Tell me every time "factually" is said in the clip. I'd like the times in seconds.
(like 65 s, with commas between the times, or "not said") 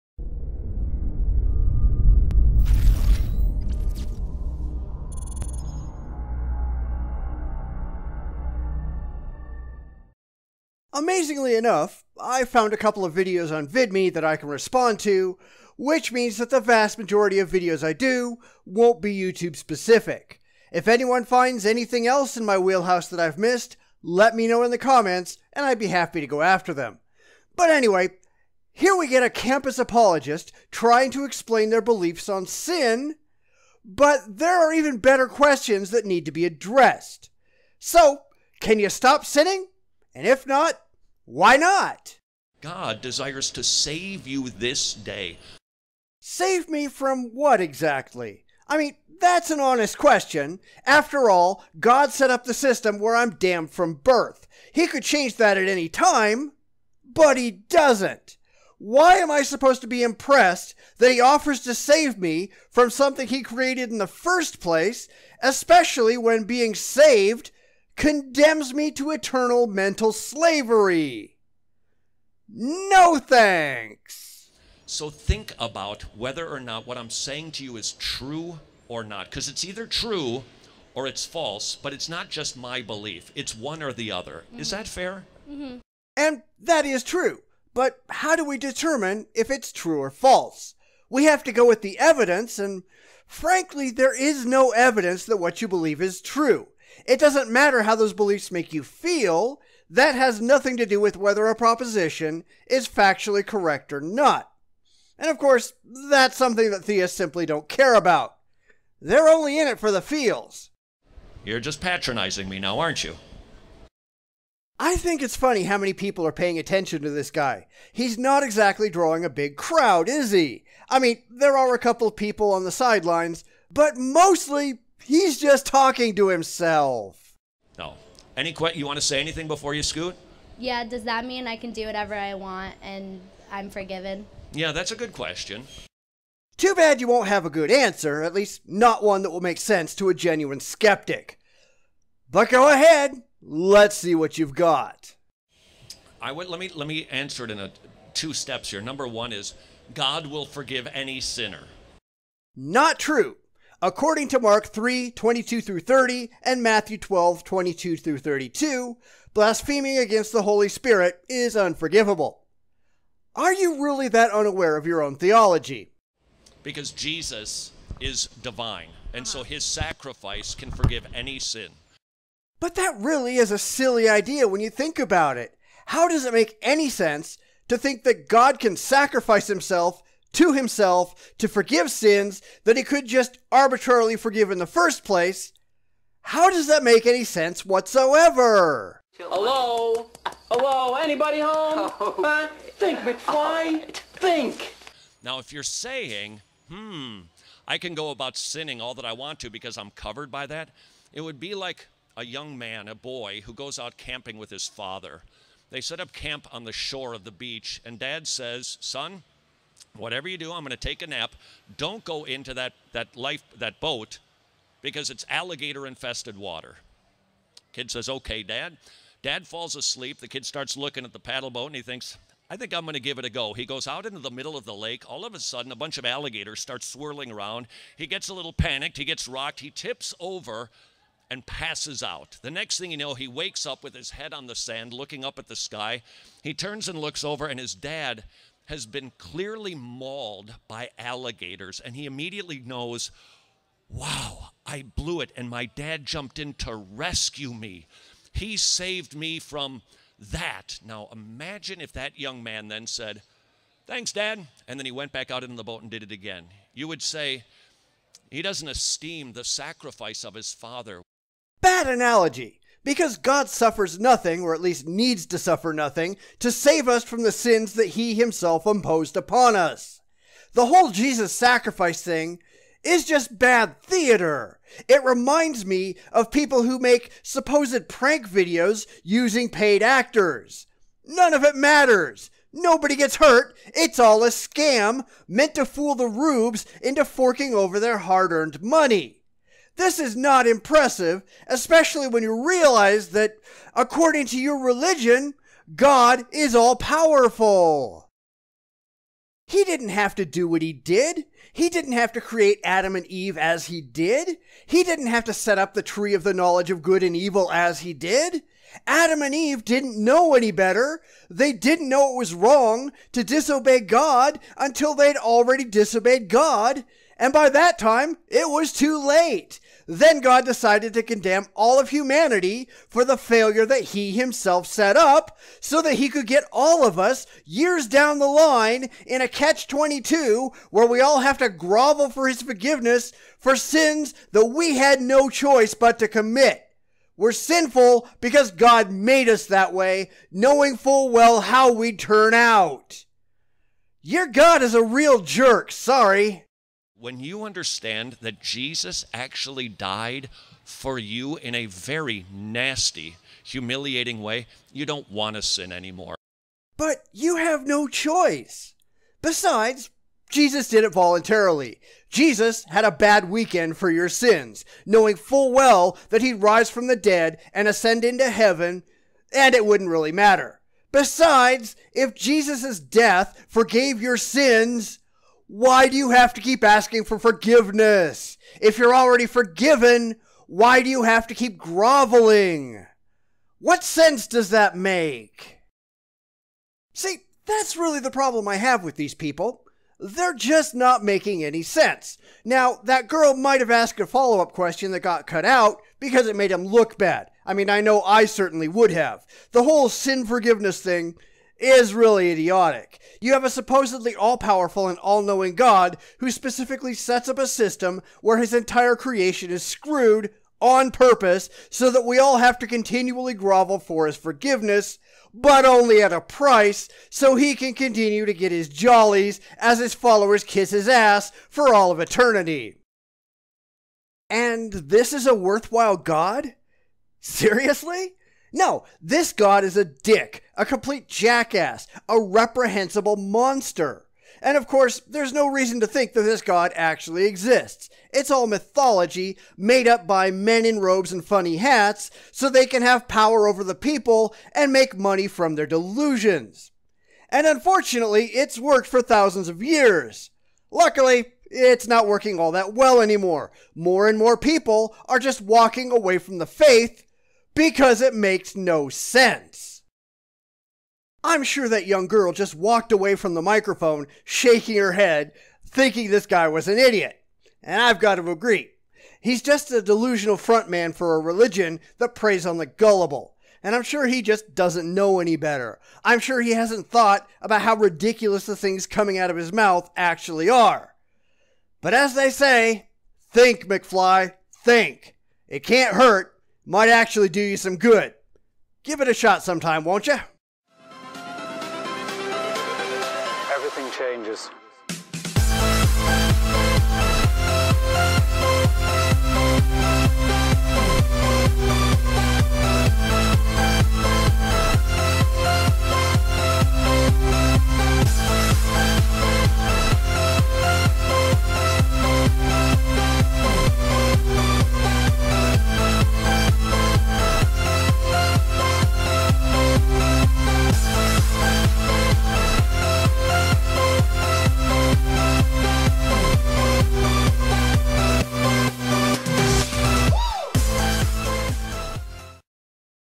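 102 s.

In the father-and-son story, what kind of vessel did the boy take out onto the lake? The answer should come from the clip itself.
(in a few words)
Paddle boat.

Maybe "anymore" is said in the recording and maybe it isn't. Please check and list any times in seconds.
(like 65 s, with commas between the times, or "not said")
355 s, 452 s.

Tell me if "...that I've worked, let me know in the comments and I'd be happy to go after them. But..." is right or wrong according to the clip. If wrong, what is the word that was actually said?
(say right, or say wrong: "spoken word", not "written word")
wrong: "missed", not "worked".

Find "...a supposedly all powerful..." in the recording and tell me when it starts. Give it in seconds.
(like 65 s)
403 s.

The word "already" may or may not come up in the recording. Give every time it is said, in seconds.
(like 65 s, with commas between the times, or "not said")
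315 s, 378 s.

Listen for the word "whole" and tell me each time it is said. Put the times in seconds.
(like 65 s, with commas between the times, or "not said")
270 s, 399 s.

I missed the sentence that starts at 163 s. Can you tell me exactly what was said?
Are you really that unaware of your own theology?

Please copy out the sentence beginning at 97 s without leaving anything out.
It doesn't matter how those beliefs make you feel.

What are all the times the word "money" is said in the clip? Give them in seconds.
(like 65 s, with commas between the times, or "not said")
288 s, 444 s.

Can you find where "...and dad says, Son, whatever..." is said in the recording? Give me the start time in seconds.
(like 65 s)
207 s.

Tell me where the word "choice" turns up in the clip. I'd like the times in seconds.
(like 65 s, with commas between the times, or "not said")
335 s, 357 s.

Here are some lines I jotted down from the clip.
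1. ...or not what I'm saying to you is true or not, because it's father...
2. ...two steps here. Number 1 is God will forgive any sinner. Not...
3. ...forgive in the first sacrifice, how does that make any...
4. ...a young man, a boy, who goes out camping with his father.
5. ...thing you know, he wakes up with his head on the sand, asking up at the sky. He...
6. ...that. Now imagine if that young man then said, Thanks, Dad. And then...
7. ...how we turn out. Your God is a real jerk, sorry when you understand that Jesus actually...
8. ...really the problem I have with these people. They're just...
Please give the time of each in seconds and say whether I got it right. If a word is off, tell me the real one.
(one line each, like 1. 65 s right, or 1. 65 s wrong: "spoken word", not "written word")
1. 76 s wrong: "either", not "father"
2. 148 s right
3. 184 s wrong: "place", not "sacrifice"
4. 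202 s right
5. 232 s wrong: "looking", not "asking"
6. 250 s right
7. 341 s right
8. 387 s right.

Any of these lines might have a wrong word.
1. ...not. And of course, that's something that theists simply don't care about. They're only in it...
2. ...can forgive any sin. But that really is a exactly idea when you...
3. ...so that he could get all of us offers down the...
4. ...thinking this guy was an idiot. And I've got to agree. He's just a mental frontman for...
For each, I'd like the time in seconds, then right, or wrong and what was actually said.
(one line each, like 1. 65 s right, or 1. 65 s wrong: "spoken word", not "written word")
1. 104 s right
2. 170 s wrong: "silly", not "exactly"
3. 325 s wrong: "years", not "offers"
4. 465 s wrong: "delusional", not "mental".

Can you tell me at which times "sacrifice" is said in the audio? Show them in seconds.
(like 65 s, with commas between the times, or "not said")
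169 s, 178 s, 259 s, 271 s.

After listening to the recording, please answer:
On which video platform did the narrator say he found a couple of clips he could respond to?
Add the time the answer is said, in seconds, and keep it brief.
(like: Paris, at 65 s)
VidMe, at 13 s.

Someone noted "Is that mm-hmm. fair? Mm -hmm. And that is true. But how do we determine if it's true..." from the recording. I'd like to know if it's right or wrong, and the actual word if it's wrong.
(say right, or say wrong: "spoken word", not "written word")
right.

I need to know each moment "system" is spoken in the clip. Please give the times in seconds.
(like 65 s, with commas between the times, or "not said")
52 s, 407 s.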